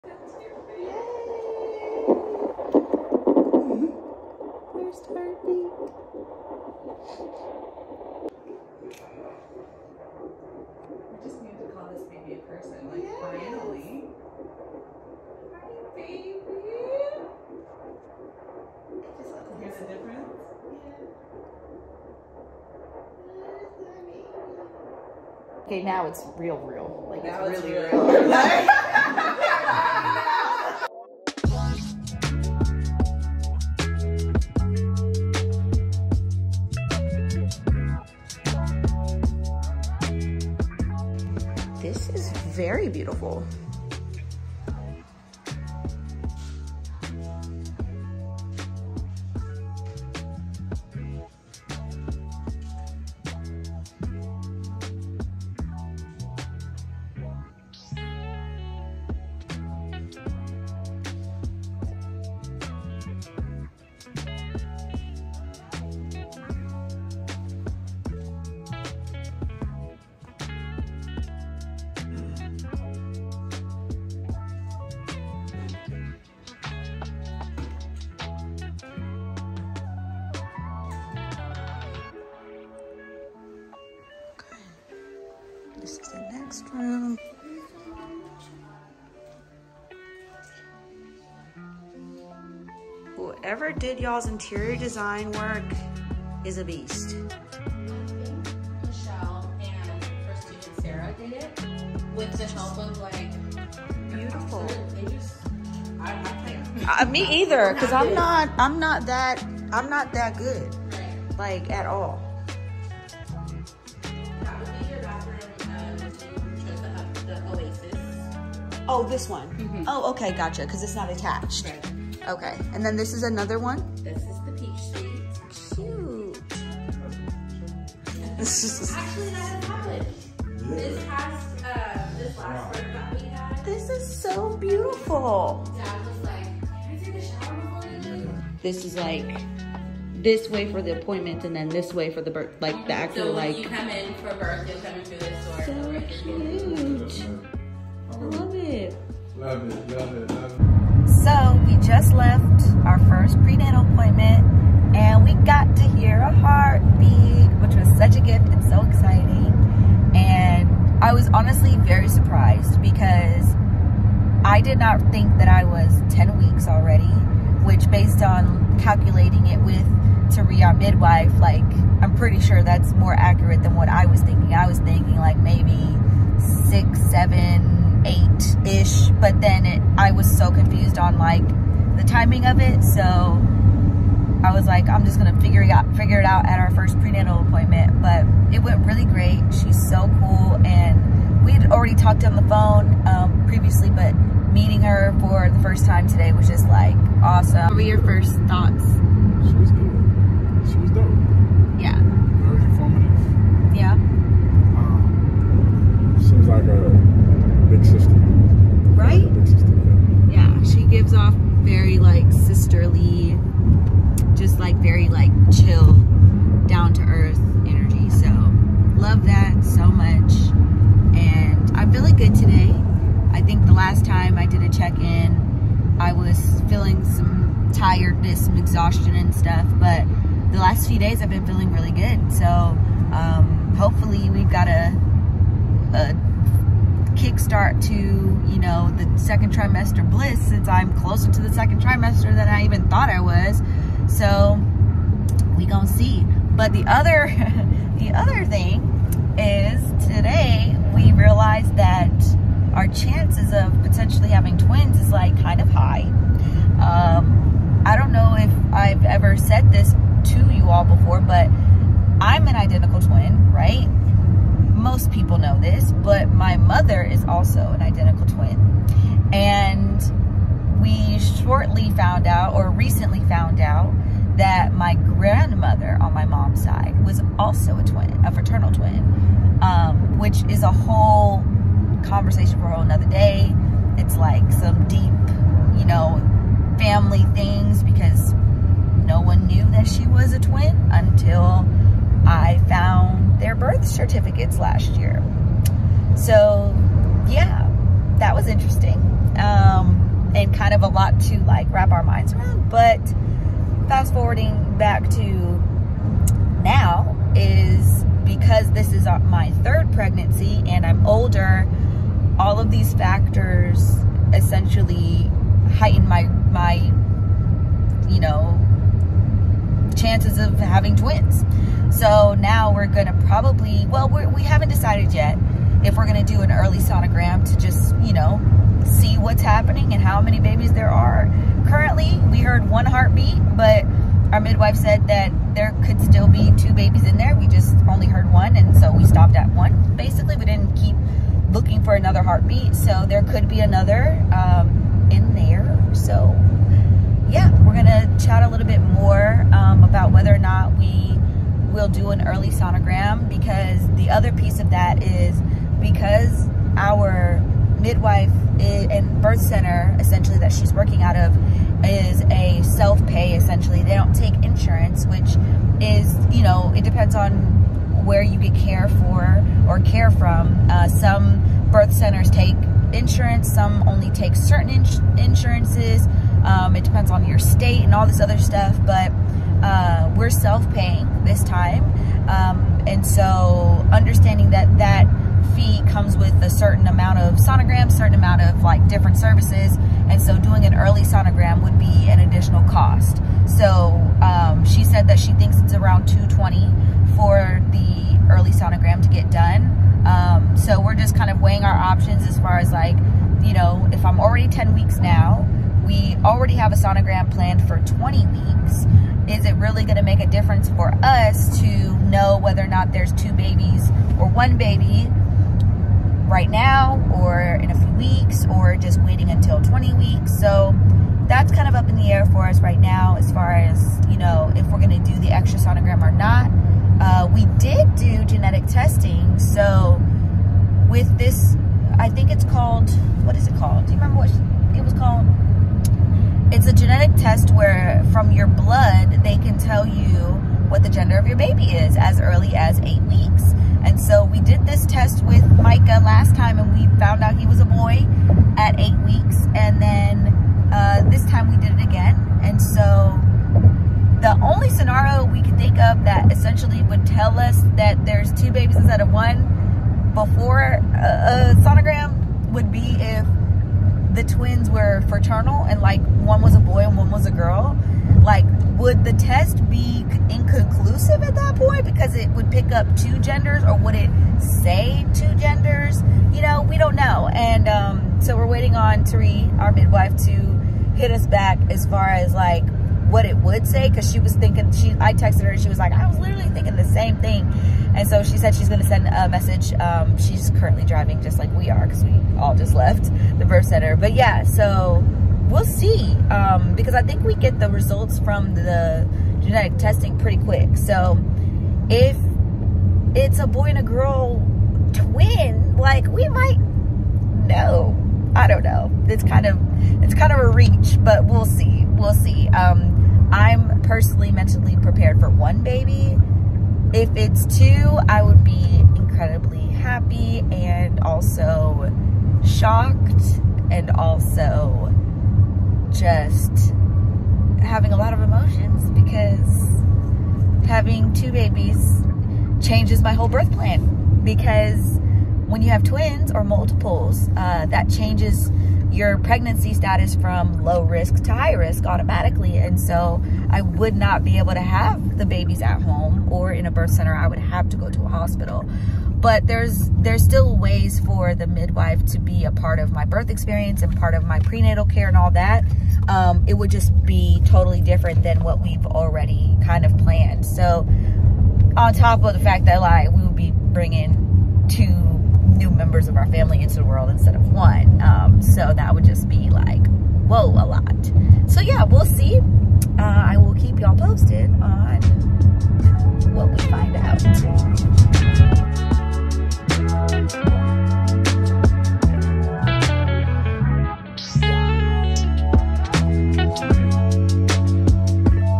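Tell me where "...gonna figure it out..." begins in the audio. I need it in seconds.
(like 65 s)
185 s.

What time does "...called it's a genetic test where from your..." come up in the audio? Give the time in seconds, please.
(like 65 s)
434 s.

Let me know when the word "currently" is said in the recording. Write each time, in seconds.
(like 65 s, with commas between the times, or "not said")
331 s, 490 s.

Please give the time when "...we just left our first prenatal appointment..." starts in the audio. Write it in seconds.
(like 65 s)
151 s.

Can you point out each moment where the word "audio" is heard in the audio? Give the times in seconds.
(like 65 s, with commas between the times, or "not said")
not said.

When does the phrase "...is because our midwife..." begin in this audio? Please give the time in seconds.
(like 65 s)
355 s.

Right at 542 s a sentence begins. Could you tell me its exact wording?
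And so I would not be able to have the babies at home or in a birth center.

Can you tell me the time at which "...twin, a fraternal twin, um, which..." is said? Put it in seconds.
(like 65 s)
277 s.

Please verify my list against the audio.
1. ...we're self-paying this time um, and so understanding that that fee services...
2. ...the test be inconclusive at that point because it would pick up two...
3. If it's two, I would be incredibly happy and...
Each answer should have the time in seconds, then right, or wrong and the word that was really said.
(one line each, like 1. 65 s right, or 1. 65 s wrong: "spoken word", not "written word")
1. 380 s wrong: "comes", not "services"
2. 469 s right
3. 516 s right.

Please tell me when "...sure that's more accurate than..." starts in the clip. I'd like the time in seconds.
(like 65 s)
172 s.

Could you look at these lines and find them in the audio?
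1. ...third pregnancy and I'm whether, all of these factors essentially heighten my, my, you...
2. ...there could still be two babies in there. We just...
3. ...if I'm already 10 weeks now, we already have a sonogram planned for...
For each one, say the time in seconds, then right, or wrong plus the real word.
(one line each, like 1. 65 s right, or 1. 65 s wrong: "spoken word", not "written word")
1. 309 s wrong: "older", not "whether"
2. 335 s right
3. 403 s right.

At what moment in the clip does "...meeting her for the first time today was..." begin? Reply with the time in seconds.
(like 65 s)
194 s.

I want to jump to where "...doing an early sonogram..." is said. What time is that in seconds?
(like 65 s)
390 s.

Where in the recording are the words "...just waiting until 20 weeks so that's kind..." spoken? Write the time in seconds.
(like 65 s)
418 s.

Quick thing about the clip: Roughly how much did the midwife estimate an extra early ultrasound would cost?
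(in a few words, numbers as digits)
220.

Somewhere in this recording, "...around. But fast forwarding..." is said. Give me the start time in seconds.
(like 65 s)
302 s.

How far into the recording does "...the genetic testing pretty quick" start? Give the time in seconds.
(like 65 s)
498 s.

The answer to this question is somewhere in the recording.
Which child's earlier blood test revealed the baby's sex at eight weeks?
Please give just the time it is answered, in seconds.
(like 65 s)
445 s.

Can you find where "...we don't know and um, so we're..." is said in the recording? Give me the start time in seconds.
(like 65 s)
476 s.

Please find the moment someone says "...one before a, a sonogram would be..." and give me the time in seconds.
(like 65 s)
459 s.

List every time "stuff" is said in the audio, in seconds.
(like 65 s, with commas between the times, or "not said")
229 s, 378 s.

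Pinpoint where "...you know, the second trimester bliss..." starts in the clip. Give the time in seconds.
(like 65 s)
237 s.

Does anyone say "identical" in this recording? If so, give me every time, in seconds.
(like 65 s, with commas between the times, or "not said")
262 s, 267 s.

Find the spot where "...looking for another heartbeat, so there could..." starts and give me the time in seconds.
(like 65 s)
341 s.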